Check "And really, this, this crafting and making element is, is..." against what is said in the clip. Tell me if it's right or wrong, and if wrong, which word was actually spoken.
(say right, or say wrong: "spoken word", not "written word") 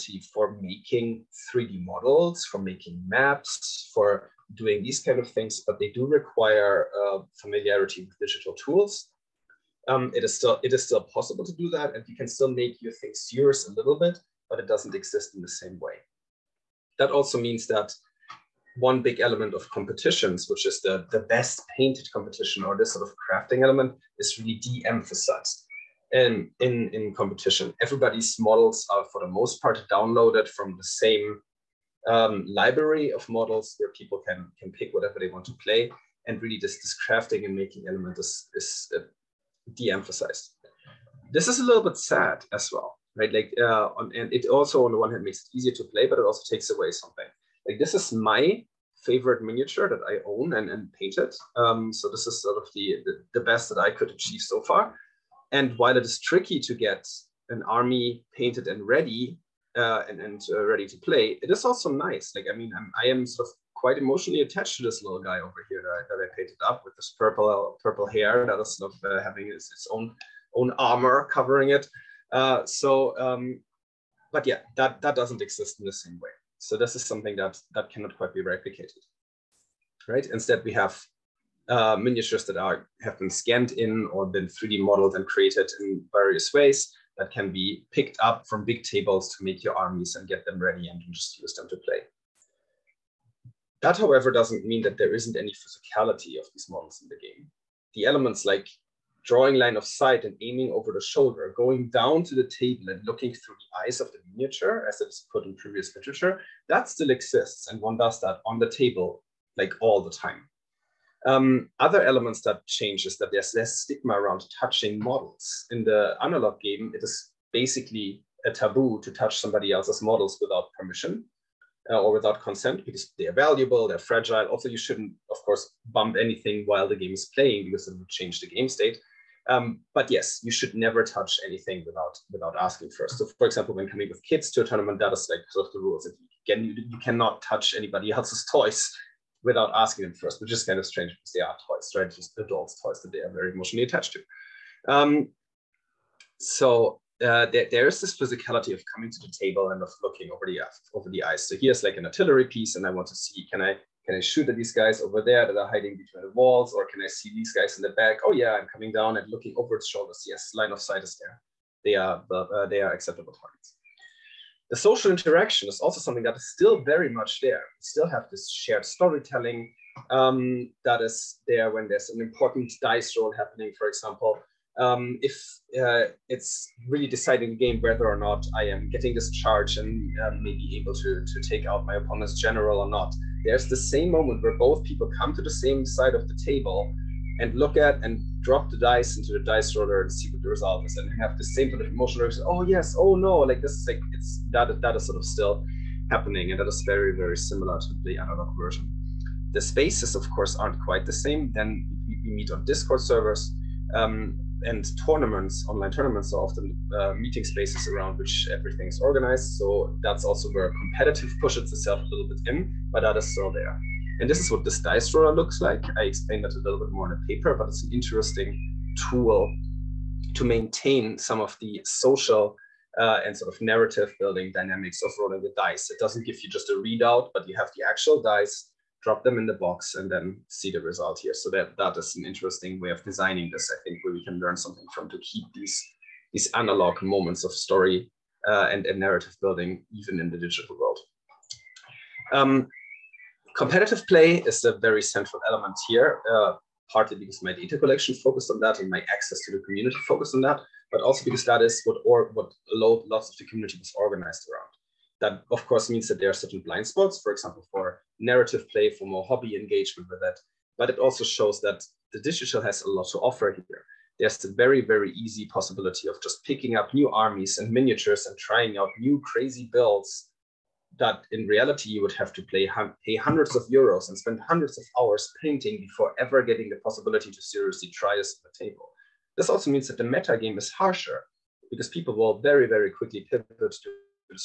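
right.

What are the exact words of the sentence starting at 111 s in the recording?
Um, other elements that change is that there's less stigma around touching models.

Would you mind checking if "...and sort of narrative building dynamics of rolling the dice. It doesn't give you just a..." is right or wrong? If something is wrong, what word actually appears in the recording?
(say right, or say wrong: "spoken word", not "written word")
right.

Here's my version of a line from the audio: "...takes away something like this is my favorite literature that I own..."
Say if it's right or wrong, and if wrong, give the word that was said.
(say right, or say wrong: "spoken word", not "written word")
wrong: "miniature", not "literature".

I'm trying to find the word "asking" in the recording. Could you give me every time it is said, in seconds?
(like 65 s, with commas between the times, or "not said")
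132 s, 139 s.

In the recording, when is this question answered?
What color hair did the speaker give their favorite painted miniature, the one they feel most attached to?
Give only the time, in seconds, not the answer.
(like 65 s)
67 s.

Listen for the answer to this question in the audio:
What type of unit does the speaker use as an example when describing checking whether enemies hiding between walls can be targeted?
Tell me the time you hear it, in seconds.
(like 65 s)
152 s.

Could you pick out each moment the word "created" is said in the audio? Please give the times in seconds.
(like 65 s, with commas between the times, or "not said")
85 s.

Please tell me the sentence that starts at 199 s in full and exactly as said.
The spaces of course aren't quite the same.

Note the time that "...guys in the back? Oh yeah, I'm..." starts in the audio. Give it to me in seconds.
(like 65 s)
157 s.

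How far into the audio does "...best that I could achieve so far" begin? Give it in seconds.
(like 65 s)
53 s.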